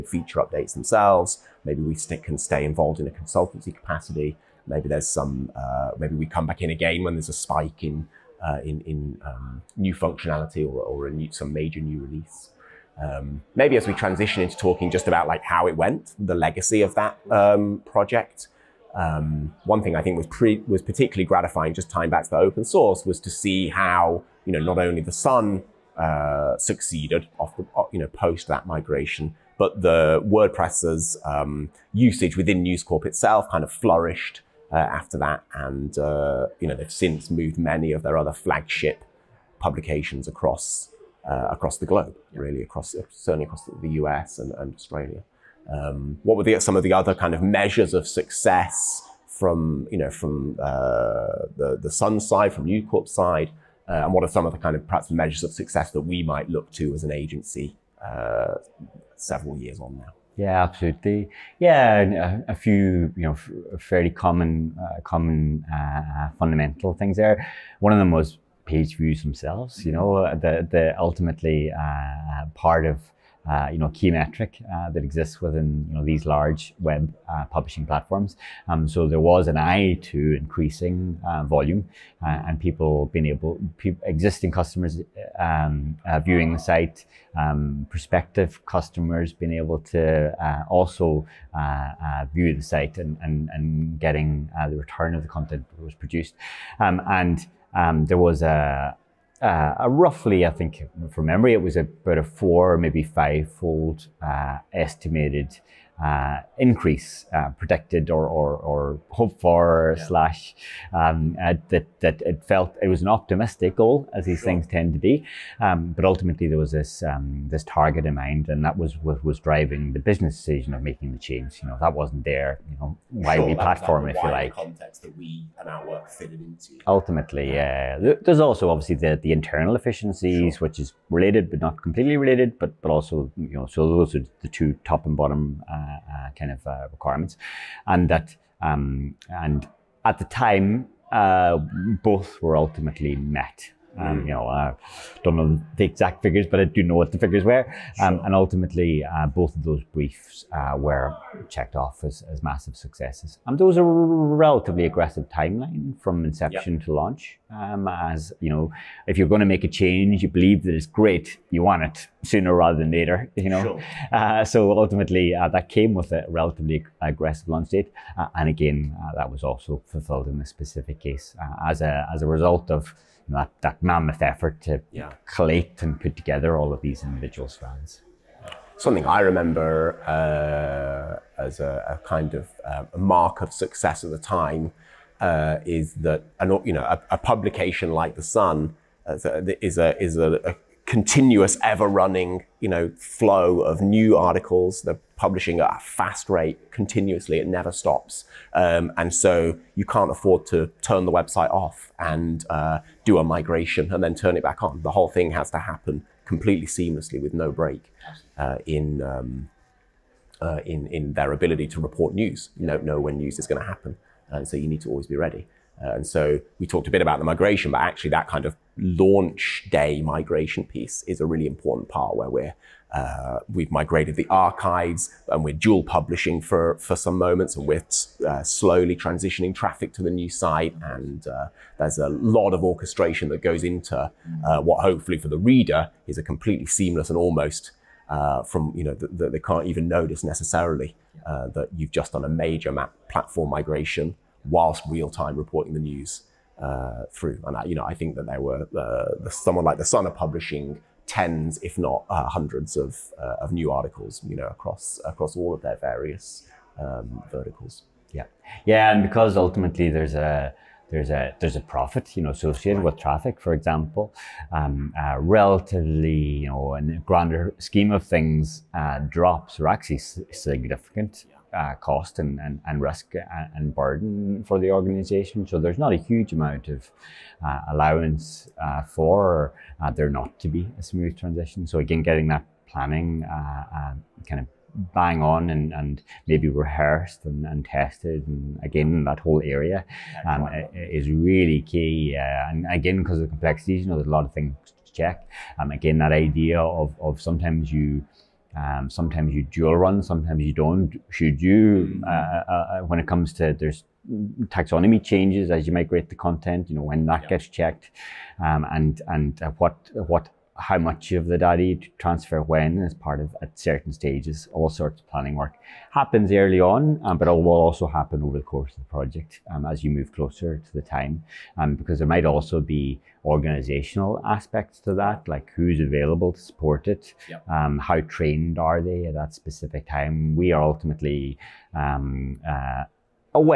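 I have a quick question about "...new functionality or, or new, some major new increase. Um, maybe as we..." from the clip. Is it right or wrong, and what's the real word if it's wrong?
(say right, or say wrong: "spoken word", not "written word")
wrong: "release", not "increase".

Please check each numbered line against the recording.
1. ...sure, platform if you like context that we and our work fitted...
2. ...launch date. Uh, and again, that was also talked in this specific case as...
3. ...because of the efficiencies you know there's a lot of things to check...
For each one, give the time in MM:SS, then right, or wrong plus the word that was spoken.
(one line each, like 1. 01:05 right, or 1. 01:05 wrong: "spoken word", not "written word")
1. 02:03 right
2. 02:47 wrong: "fulfilled", not "talked"
3. 04:53 wrong: "complexities", not "efficiencies".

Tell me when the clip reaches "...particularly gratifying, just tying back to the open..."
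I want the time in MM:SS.
00:20.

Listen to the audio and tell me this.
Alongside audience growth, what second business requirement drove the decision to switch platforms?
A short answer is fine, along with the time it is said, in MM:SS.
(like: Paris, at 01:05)
Internal efficiencies, at 02:09.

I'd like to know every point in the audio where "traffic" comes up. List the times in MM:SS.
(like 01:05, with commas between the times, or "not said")
03:49, 04:22.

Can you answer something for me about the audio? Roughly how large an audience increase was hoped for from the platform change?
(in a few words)
4 or 5 fold.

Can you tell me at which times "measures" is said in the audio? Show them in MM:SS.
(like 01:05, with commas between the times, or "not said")
00:47, 00:55.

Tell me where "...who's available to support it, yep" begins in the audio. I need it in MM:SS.
05:25.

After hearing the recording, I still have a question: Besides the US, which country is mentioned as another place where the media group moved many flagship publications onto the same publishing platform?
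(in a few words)
Australia.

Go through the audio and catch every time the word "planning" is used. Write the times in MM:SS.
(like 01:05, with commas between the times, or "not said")
04:42, 05:15.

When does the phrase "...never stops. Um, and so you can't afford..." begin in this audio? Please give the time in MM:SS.
03:17.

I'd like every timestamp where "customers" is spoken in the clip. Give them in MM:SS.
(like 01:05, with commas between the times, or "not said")
01:24, 01:28.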